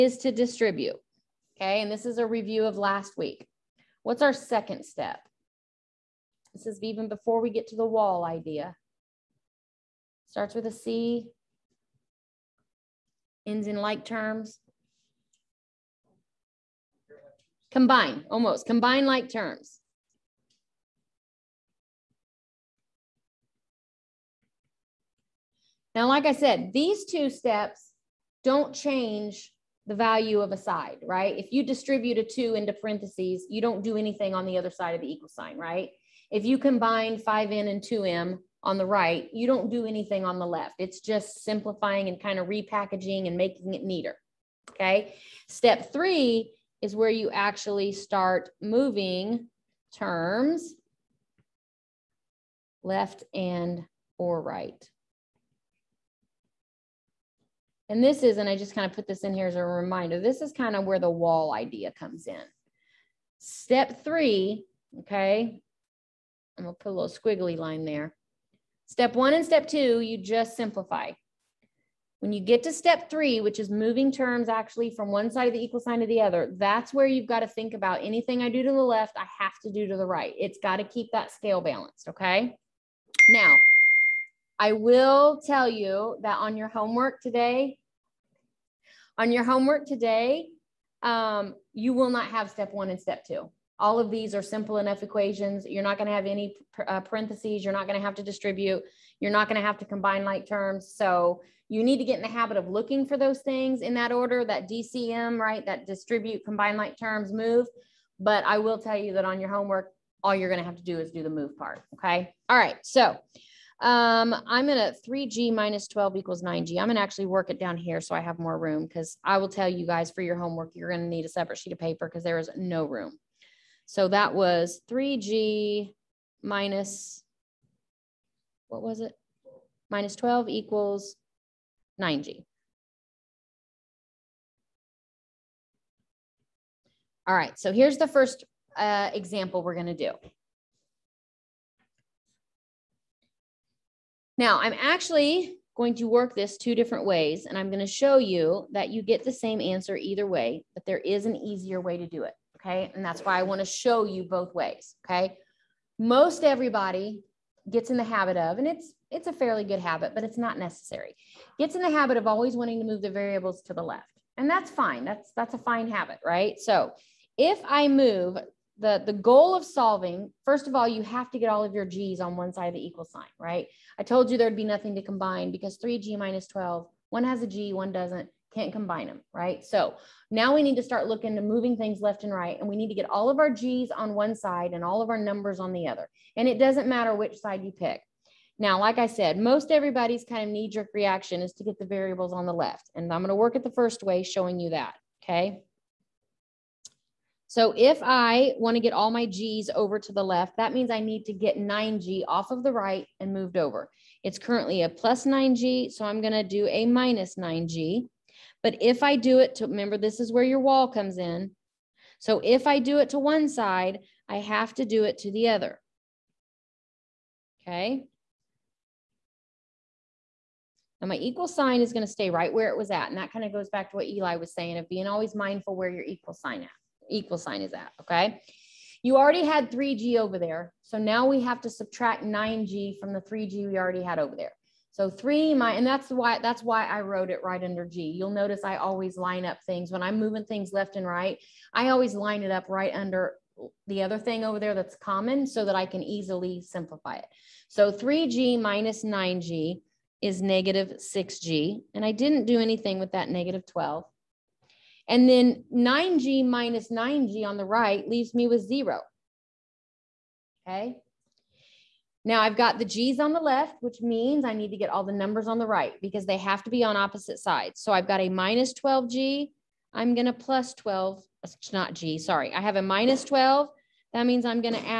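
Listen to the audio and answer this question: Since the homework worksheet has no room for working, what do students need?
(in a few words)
a separate sheet of paper.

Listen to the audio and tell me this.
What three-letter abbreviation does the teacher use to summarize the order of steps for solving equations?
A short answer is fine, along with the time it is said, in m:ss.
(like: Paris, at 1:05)
DCM, at 1:44.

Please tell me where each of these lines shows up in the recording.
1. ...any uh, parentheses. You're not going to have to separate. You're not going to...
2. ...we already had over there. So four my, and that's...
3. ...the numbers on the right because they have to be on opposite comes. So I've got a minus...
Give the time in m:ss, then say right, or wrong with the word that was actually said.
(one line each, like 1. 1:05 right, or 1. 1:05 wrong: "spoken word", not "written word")
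1. 1:36 wrong: "distribute", not "separate"
2. 3:53 wrong: "three", not "four"
3. 4:25 wrong: "sides", not "comes".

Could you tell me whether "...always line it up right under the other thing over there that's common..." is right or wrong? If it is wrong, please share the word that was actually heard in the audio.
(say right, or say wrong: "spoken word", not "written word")
right.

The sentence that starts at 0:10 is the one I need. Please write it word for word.
Starts with a C, ends in like terms?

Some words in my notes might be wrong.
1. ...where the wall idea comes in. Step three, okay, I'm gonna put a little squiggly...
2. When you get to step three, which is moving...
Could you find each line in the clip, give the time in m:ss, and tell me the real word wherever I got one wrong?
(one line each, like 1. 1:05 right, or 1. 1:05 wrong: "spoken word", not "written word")
1. 1:00 right
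2. 1:12 right.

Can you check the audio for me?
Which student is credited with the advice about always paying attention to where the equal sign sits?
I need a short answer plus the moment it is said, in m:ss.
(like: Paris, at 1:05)
Eli, at 3:44.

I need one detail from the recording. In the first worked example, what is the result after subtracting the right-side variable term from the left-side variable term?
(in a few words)
negative 6G.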